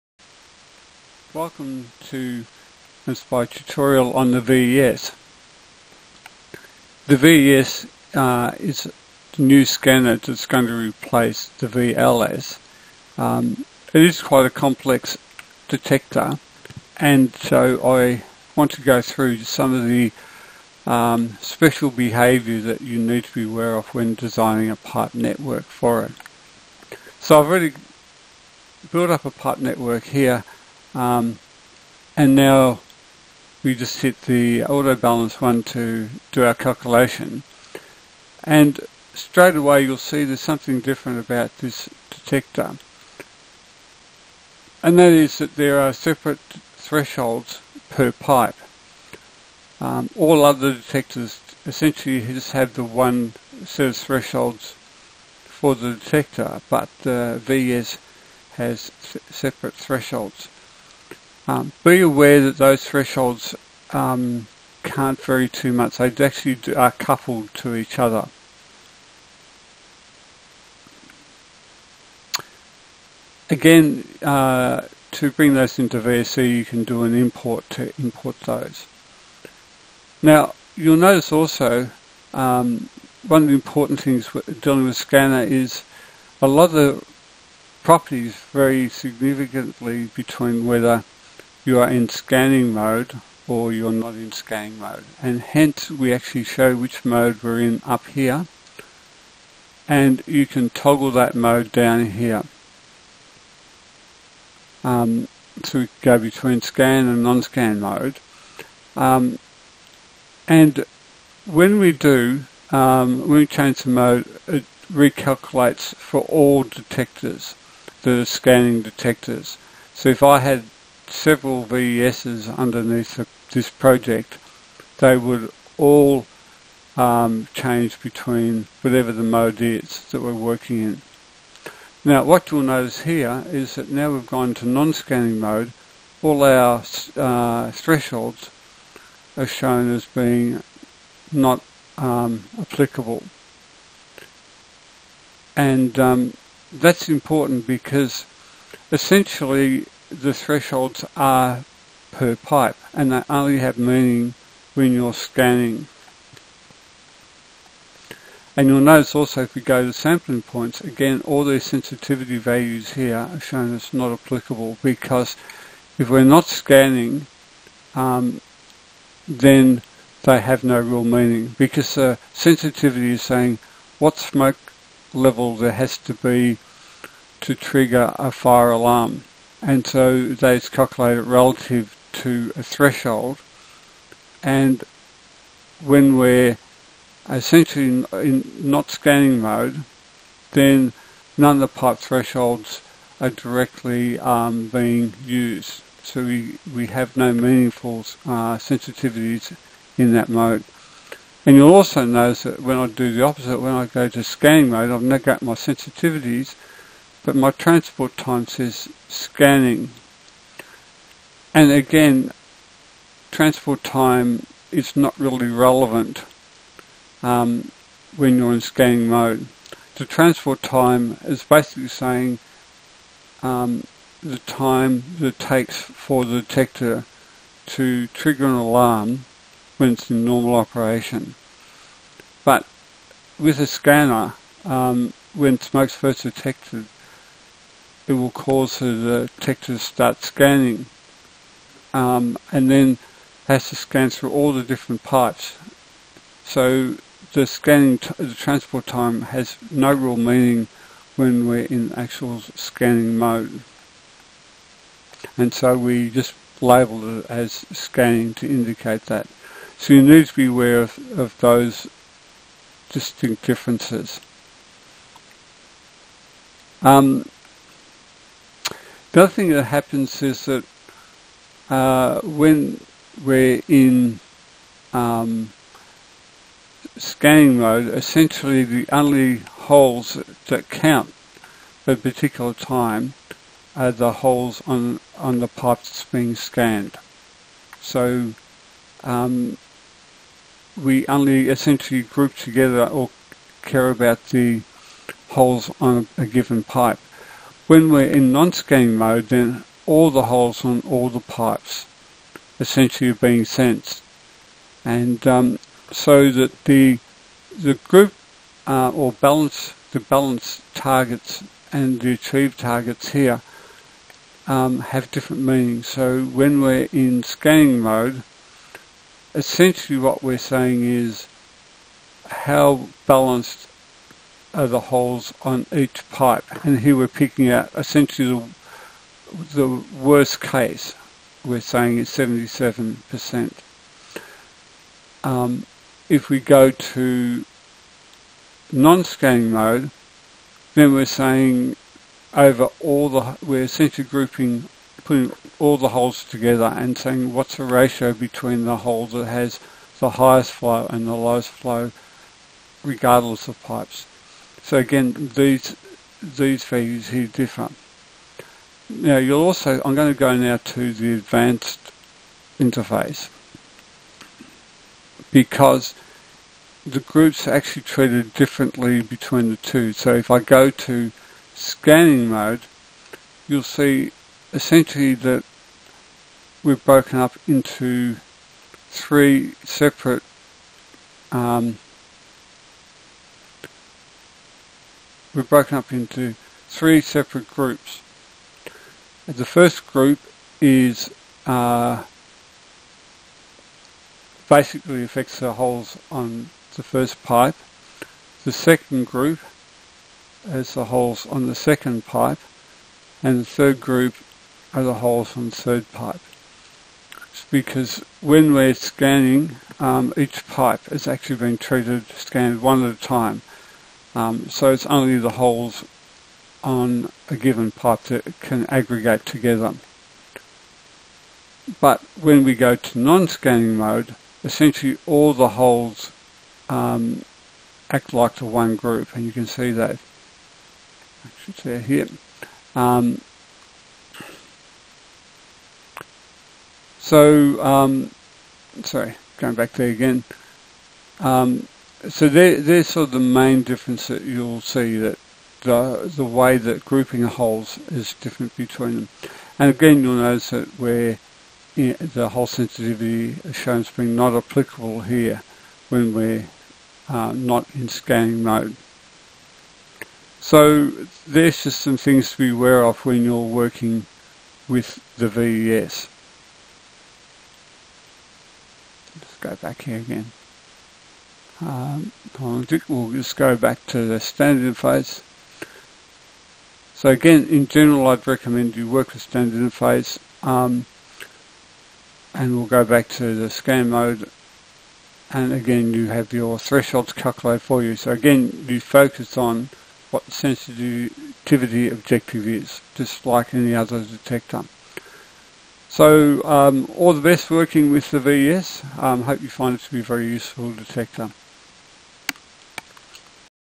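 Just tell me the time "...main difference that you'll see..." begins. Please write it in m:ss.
7:23.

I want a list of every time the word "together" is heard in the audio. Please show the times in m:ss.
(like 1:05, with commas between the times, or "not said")
4:52, 5:46, 6:59.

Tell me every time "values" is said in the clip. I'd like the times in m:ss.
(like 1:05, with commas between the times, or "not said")
2:42, 5:56.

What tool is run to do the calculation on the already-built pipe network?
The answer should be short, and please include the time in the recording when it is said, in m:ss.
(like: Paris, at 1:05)
auto balance, at 0:34.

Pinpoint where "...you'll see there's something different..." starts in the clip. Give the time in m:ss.
0:39.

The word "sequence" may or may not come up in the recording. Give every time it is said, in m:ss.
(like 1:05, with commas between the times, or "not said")
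not said.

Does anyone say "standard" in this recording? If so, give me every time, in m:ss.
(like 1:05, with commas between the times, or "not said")
7:54, 7:59.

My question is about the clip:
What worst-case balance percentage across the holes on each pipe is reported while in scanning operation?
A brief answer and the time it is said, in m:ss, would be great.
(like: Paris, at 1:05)
77%, at 5:32.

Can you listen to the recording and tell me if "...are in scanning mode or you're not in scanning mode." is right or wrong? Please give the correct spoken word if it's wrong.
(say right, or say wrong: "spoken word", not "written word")
right.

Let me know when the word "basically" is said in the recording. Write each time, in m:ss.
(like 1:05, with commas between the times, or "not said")
3:41, 6:34.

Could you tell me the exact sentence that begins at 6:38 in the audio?
The second group is the holes on the second pipe and the third group are the holes on the third pipe.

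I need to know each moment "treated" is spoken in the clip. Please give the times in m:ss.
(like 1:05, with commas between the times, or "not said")
6:07, 6:51.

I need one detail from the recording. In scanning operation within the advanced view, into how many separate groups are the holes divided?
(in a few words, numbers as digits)
3.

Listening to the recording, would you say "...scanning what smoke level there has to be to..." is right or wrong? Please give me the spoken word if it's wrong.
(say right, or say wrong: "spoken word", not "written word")
wrong: "saying", not "scanning".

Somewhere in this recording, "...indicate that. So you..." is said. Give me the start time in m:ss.
4:18.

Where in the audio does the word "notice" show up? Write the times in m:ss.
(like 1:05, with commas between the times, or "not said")
1:20, 2:12, 2:38, 3:22, 7:30.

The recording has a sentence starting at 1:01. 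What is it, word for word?
Um, be aware that those thresholds um, can't vary too much.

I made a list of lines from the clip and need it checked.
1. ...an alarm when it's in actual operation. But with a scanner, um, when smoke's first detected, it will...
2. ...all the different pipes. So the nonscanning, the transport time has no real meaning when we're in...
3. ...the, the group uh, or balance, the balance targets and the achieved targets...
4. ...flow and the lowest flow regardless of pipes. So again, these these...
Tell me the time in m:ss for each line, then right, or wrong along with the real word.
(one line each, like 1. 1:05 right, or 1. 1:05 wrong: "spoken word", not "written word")
1. 3:48 wrong: "normal", not "actual"
2. 4:04 wrong: "scanning", not "nonscanning"
3. 5:06 right
4. 5:50 right.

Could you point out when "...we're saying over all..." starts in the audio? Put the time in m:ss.
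5:40.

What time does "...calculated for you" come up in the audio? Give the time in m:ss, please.
8:07.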